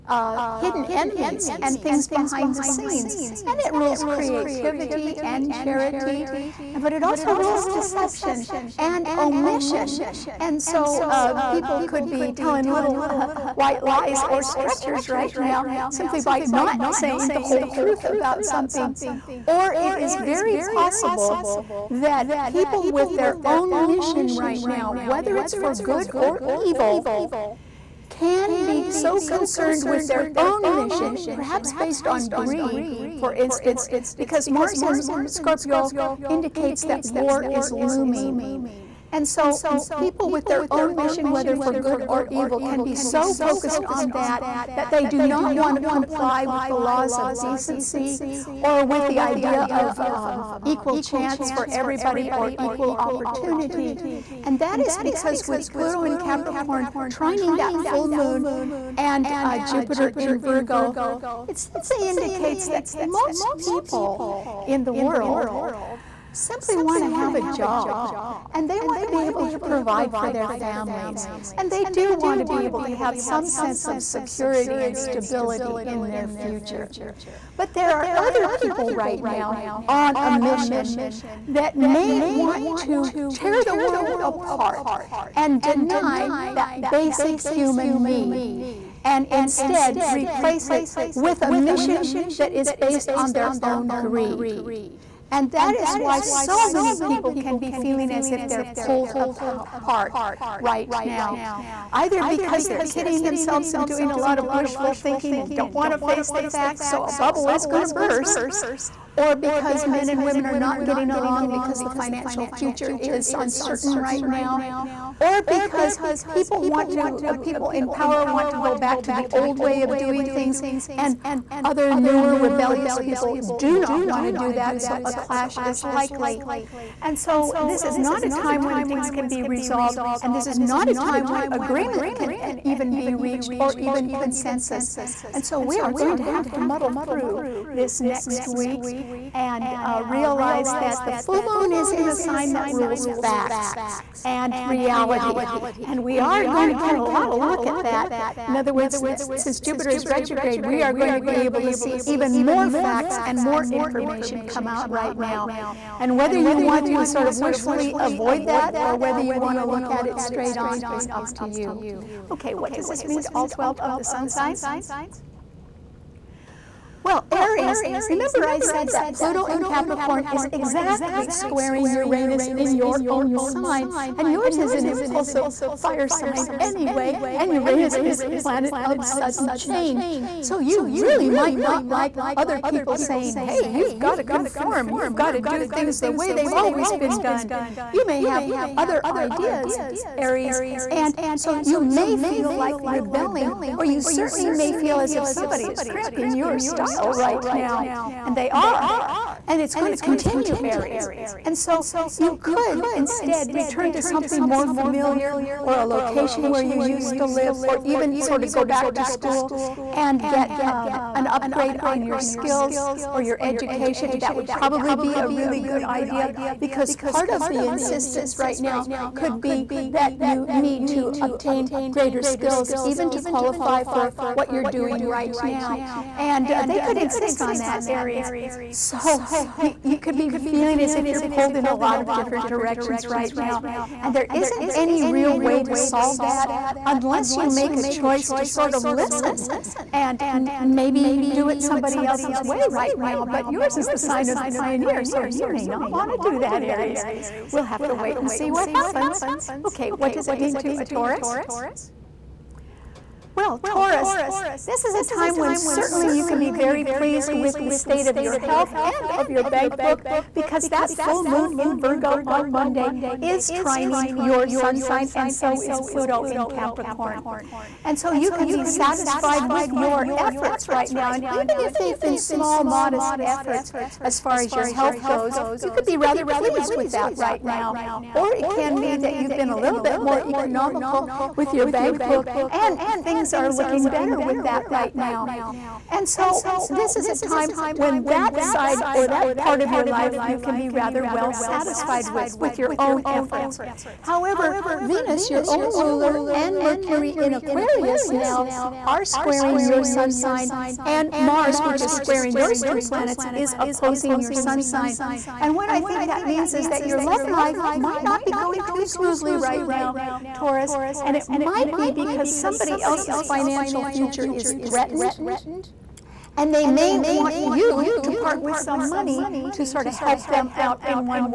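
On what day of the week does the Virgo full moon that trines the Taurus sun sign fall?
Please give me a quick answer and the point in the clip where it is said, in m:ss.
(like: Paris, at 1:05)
Monday, at 4:22.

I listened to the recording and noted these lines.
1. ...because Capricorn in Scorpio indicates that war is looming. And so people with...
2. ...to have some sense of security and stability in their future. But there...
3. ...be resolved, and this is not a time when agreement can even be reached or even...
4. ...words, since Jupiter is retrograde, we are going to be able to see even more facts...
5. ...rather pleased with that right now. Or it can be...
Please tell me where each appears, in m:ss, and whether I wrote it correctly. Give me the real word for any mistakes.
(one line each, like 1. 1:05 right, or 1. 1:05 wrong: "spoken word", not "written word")
1. 0:34 wrong: "Mars", not "Capricorn"
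2. 1:12 right
3. 2:09 right
4. 2:28 right
5. 4:35 right.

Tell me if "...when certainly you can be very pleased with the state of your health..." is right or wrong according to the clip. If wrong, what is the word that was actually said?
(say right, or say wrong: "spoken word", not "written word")
right.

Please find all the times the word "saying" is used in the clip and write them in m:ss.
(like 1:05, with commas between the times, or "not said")
0:16, 3:02.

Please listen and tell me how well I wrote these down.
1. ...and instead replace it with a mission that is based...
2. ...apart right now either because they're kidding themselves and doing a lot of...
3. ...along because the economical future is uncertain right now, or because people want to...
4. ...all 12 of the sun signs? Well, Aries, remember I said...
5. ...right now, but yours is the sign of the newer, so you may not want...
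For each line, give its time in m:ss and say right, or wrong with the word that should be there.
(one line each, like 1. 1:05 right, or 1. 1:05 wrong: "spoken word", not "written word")
1. 1:29 right
2. 1:39 right
3. 1:51 wrong: "financial", not "economical"
4. 2:43 right
5. 4:02 wrong: "pioneer", not "newer".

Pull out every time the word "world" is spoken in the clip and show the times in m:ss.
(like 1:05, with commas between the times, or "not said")
1:04, 1:23.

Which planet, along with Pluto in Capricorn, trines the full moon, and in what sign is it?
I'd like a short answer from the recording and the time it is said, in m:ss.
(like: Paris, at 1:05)
Jupiter in Virgo, at 0:59.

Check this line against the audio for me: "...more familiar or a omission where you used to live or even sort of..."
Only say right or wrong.
wrong.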